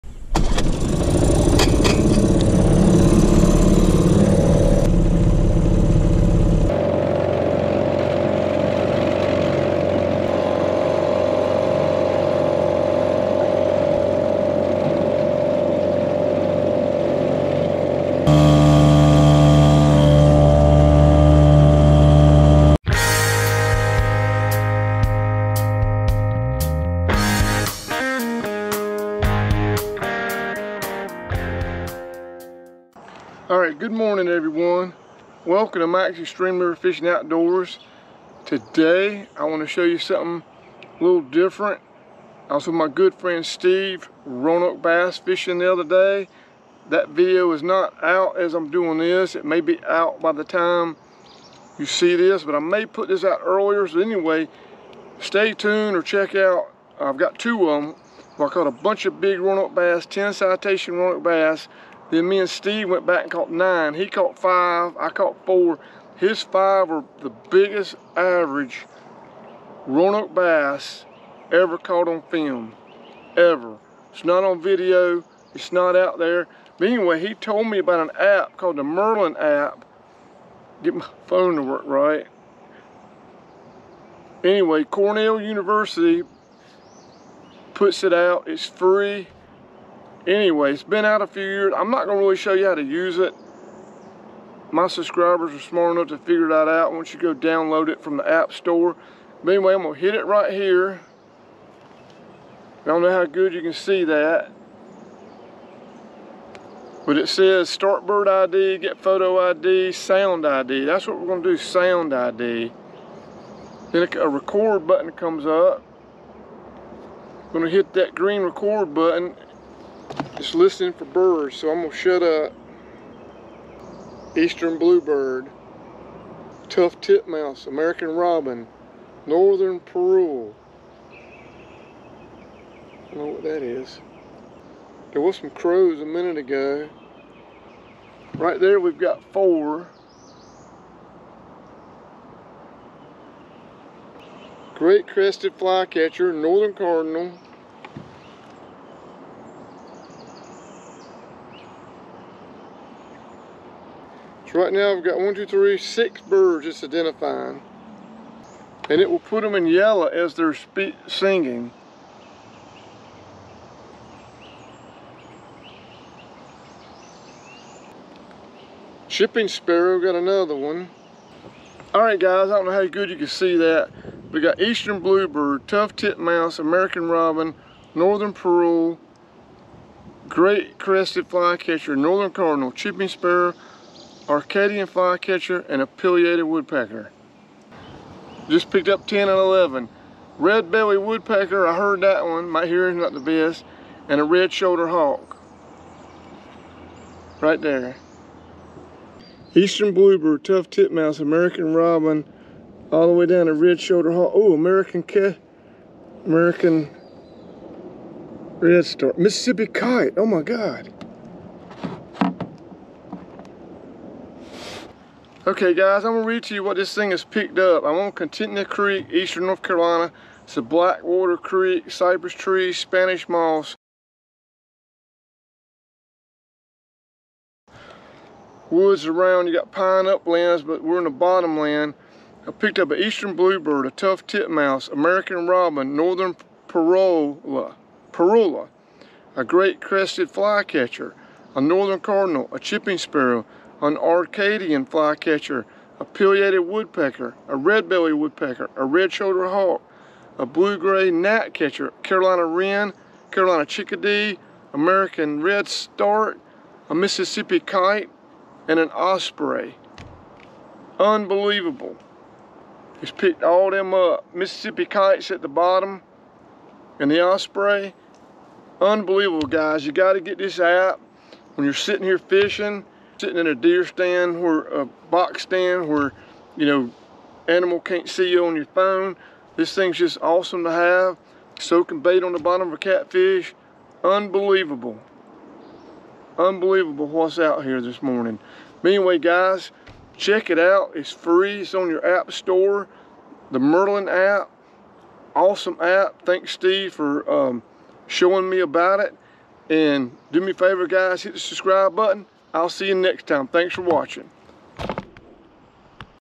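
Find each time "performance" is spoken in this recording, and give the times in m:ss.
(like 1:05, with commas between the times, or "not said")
not said.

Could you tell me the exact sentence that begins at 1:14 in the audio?
It's not on video, it's not out there.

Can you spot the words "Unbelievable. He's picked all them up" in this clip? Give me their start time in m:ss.
4:20.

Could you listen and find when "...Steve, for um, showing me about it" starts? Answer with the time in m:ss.
4:56.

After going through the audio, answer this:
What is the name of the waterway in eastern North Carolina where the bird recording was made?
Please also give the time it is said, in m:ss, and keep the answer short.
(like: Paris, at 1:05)
Contentnea Creek, at 3:38.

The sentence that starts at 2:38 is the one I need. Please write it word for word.
And it will put them in yellow as they're singing.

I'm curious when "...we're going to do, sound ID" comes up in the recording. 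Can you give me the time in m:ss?
1:51.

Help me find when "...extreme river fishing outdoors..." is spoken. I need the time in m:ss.
0:36.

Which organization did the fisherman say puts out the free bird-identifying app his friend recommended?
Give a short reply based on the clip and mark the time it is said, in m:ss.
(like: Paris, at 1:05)
Cornell University, at 1:24.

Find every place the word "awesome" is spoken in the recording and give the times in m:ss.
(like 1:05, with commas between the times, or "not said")
4:40, 4:55.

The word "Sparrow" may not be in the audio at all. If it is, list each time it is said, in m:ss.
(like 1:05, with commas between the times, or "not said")
2:49, 3:03, 4:02.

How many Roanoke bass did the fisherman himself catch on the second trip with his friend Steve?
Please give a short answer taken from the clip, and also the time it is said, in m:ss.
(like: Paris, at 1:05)
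4, at 1:04.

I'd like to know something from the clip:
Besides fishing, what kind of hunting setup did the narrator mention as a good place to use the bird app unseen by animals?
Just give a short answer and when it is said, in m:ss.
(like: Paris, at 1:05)
Box stand, at 4:35.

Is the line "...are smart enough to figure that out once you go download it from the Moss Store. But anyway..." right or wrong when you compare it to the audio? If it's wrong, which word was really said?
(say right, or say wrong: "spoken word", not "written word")
wrong: "App", not "Moss".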